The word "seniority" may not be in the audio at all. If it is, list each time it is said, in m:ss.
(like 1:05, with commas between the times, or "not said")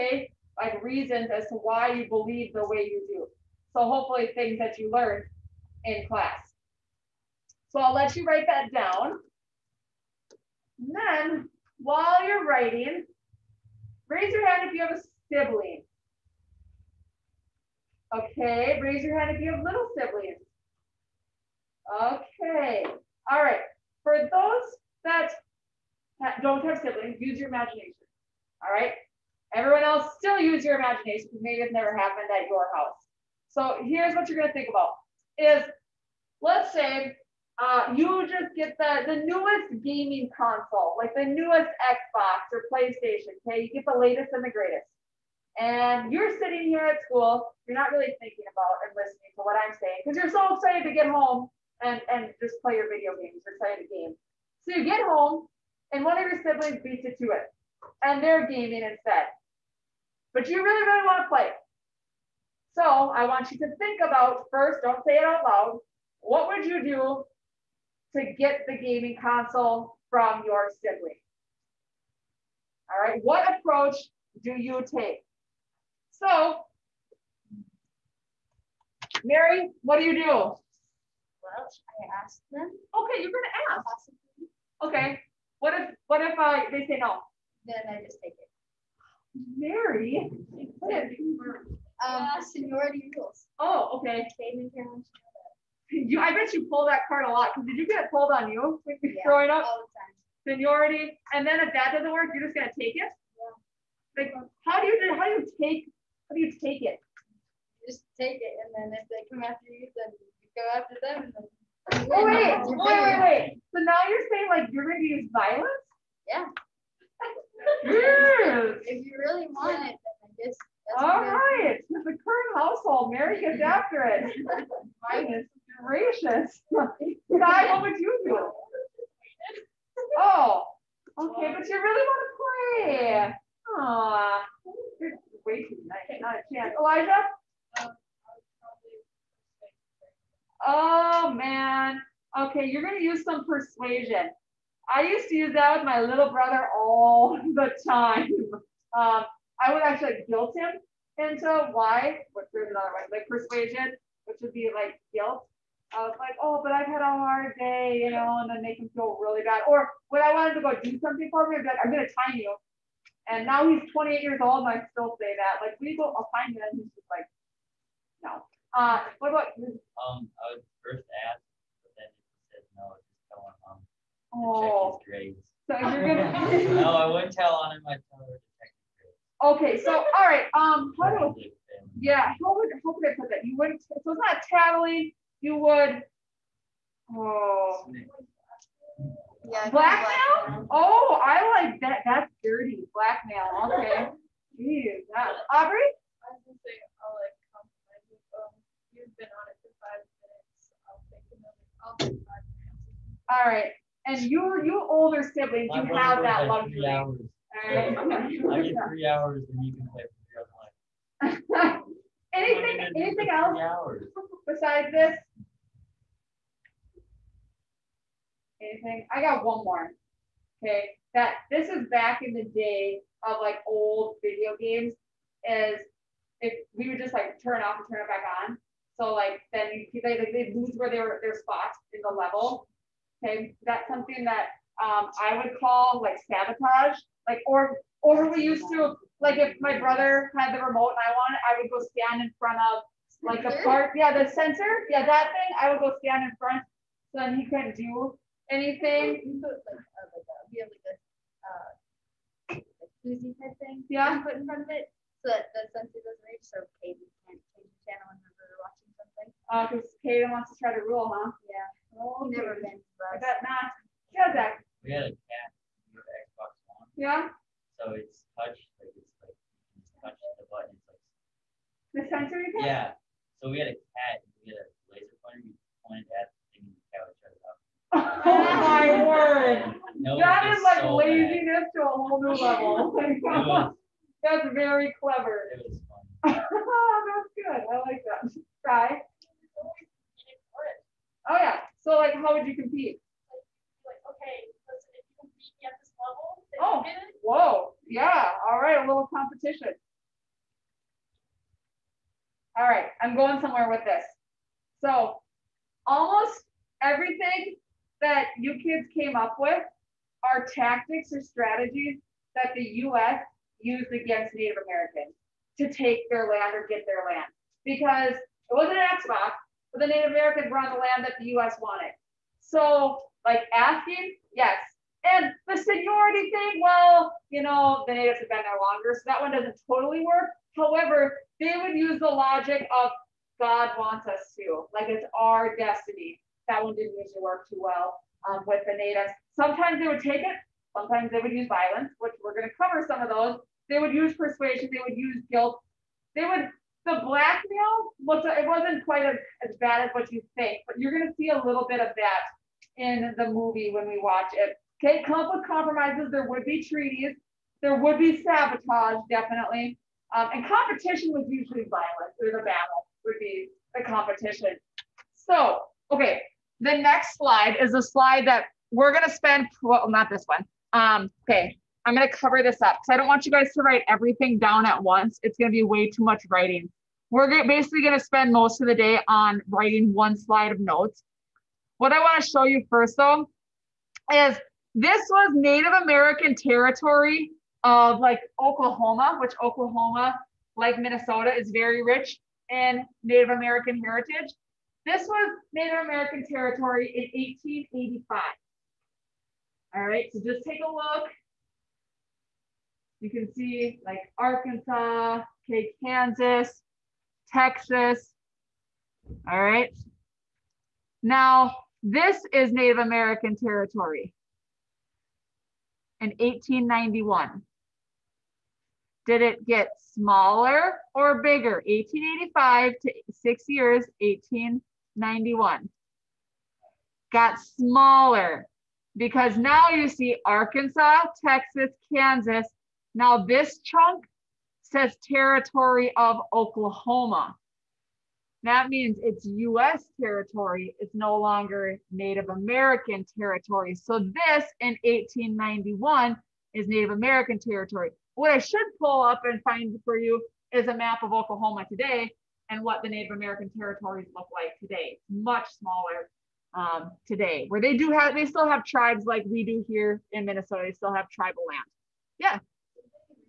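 1:32, 1:40, 5:25.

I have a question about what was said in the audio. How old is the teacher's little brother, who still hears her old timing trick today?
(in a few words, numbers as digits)
28.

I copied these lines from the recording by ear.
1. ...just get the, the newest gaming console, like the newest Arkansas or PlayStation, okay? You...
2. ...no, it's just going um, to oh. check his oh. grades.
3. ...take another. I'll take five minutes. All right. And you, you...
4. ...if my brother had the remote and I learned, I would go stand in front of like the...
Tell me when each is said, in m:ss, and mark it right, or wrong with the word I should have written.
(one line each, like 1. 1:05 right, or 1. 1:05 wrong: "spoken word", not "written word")
1. 0:38 wrong: "Xbox", not "Arkansas"
2. 2:52 right
3. 3:21 right
4. 3:59 wrong: "wanted", not "learned".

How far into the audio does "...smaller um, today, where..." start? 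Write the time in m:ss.
7:35.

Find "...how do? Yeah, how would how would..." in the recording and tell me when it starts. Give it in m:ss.
3:01.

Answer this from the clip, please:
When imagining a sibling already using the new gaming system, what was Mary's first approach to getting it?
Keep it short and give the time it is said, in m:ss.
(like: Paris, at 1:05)
Ask them, at 1:21.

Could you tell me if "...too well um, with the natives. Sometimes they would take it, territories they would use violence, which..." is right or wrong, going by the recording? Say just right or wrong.
wrong.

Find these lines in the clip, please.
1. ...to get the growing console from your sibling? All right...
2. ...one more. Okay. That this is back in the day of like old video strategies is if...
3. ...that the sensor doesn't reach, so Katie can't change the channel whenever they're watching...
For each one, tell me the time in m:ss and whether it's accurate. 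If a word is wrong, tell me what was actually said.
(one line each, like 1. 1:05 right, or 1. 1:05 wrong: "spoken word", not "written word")
1. 1:08 wrong: "gaming", not "growing"
2. 3:39 wrong: "games", not "strategies"
3. 4:15 right.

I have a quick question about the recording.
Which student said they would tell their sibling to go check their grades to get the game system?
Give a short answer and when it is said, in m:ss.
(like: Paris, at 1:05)
Elijah, at 2:16.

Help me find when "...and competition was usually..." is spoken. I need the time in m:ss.
6:00.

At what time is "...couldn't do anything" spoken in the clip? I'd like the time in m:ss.
4:07.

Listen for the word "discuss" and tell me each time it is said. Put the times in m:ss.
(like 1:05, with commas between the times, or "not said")
not said.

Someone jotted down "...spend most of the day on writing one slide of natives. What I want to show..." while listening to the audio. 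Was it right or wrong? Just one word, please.
wrong.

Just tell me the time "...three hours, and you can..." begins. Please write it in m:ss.
3:28.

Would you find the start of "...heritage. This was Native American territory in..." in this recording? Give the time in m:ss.
6:33.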